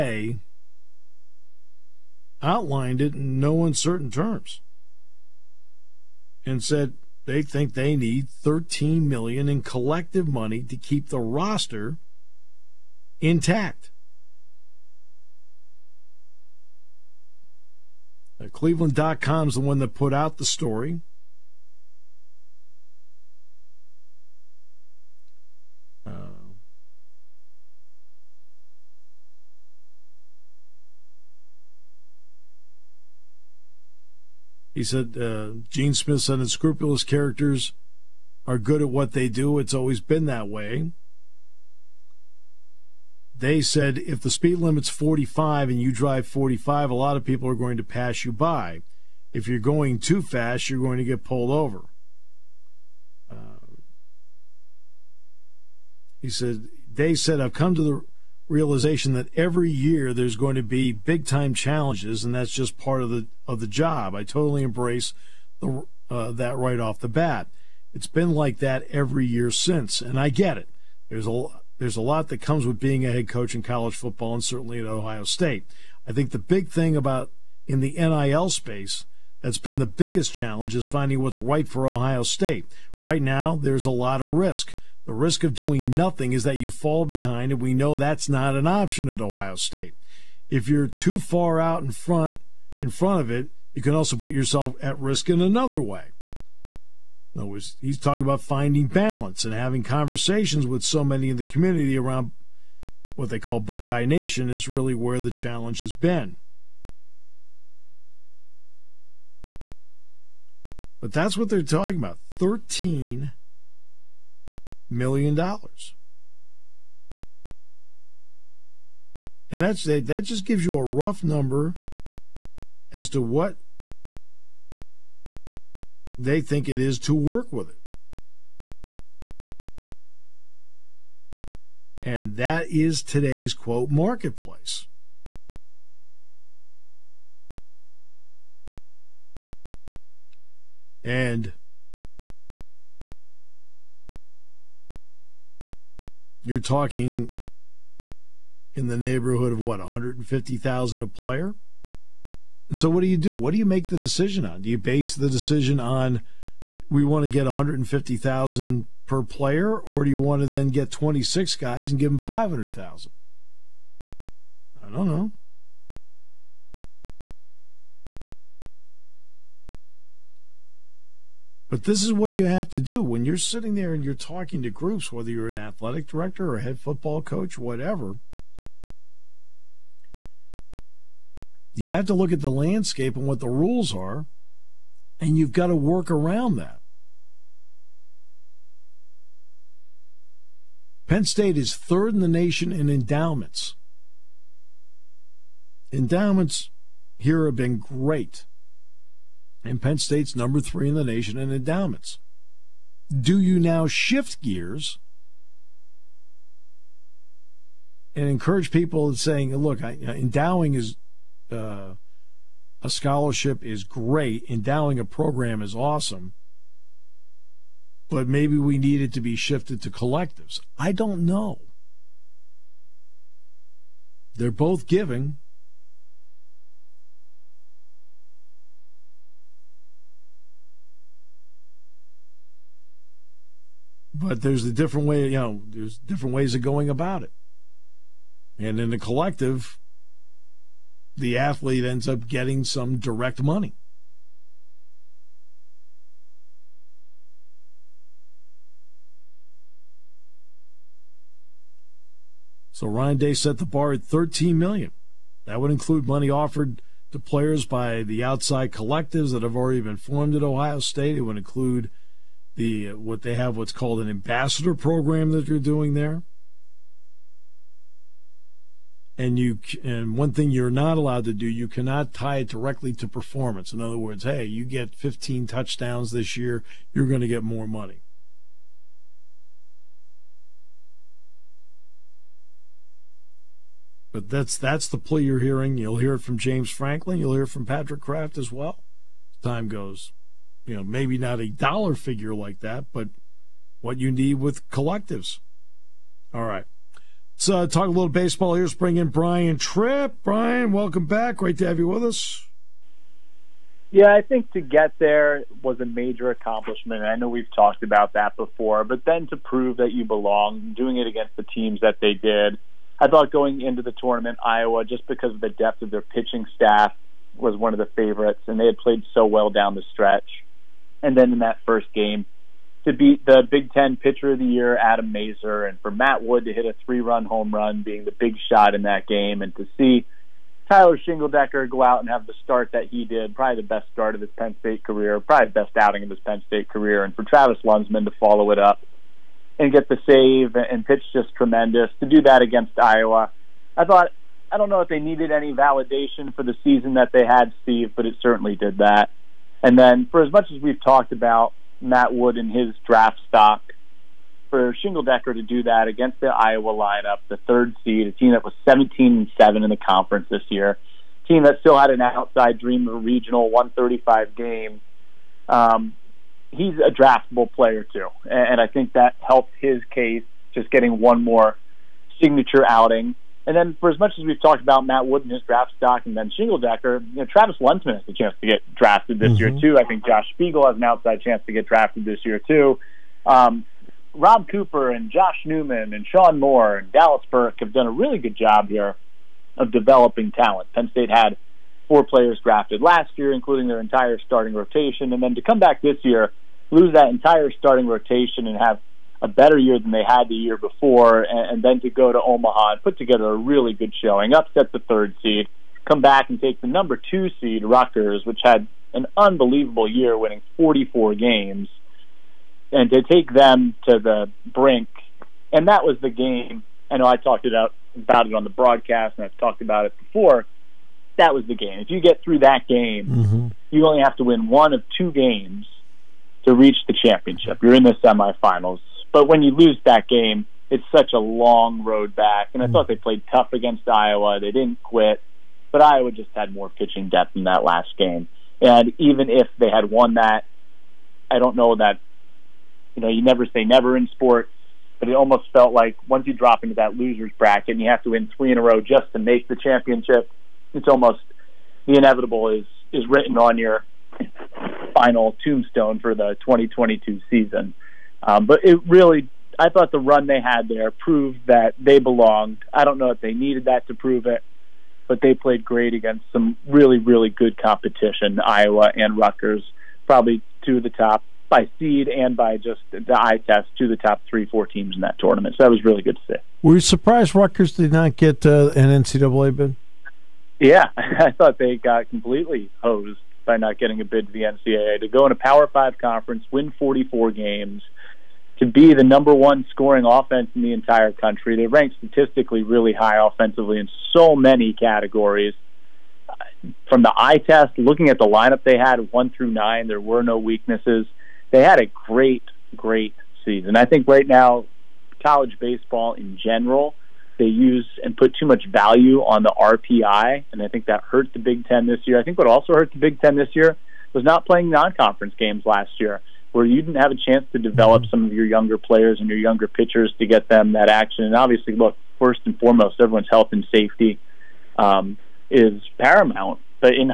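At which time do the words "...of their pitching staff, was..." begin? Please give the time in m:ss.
5:15.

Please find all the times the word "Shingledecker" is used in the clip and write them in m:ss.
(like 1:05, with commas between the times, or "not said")
5:30, 5:54, 6:16.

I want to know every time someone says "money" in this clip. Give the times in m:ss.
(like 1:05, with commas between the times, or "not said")
0:10, 4:03, 4:16, 4:37.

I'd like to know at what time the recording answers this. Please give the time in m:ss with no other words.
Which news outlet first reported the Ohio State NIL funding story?
0:18.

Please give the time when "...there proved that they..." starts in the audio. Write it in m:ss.
7:40.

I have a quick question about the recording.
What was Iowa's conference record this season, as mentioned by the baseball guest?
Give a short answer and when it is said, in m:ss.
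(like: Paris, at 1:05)
17 and 7, at 5:58.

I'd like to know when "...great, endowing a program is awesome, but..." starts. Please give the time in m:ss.
3:33.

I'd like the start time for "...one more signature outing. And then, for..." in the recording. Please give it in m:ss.
6:10.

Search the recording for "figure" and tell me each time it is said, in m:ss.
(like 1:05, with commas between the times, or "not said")
4:51.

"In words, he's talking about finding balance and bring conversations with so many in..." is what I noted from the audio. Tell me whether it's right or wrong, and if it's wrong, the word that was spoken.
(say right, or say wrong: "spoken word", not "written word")
wrong: "having", not "bring".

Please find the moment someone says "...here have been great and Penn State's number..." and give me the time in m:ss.
3:17.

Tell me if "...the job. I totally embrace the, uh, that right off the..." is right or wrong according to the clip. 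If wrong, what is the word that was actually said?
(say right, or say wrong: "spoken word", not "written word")
right.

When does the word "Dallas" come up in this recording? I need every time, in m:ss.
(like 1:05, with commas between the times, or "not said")
6:26.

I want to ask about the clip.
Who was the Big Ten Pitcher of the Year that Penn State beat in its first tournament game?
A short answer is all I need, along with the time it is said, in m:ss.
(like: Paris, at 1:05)
Adam Mazur, at 5:24.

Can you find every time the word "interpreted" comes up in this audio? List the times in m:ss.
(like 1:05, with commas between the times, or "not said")
not said.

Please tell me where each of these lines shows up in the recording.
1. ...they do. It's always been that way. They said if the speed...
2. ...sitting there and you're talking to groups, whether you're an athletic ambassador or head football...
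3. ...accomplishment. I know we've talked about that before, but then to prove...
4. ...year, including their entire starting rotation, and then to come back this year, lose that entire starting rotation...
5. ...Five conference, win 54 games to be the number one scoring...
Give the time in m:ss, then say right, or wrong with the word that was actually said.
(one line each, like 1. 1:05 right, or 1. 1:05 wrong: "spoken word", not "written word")
1. 0:39 right
2. 2:53 wrong: "director", not "ambassador"
3. 5:06 right
4. 6:33 right
5. 8:05 wrong: "44", not "54".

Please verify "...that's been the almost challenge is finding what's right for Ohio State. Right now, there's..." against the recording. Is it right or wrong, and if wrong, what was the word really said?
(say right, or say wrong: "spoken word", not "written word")
wrong: "biggest", not "almost".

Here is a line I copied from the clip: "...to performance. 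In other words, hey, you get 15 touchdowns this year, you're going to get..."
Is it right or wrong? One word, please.
right.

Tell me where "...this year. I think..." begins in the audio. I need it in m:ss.
8:31.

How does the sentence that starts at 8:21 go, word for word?
They had a great, great season.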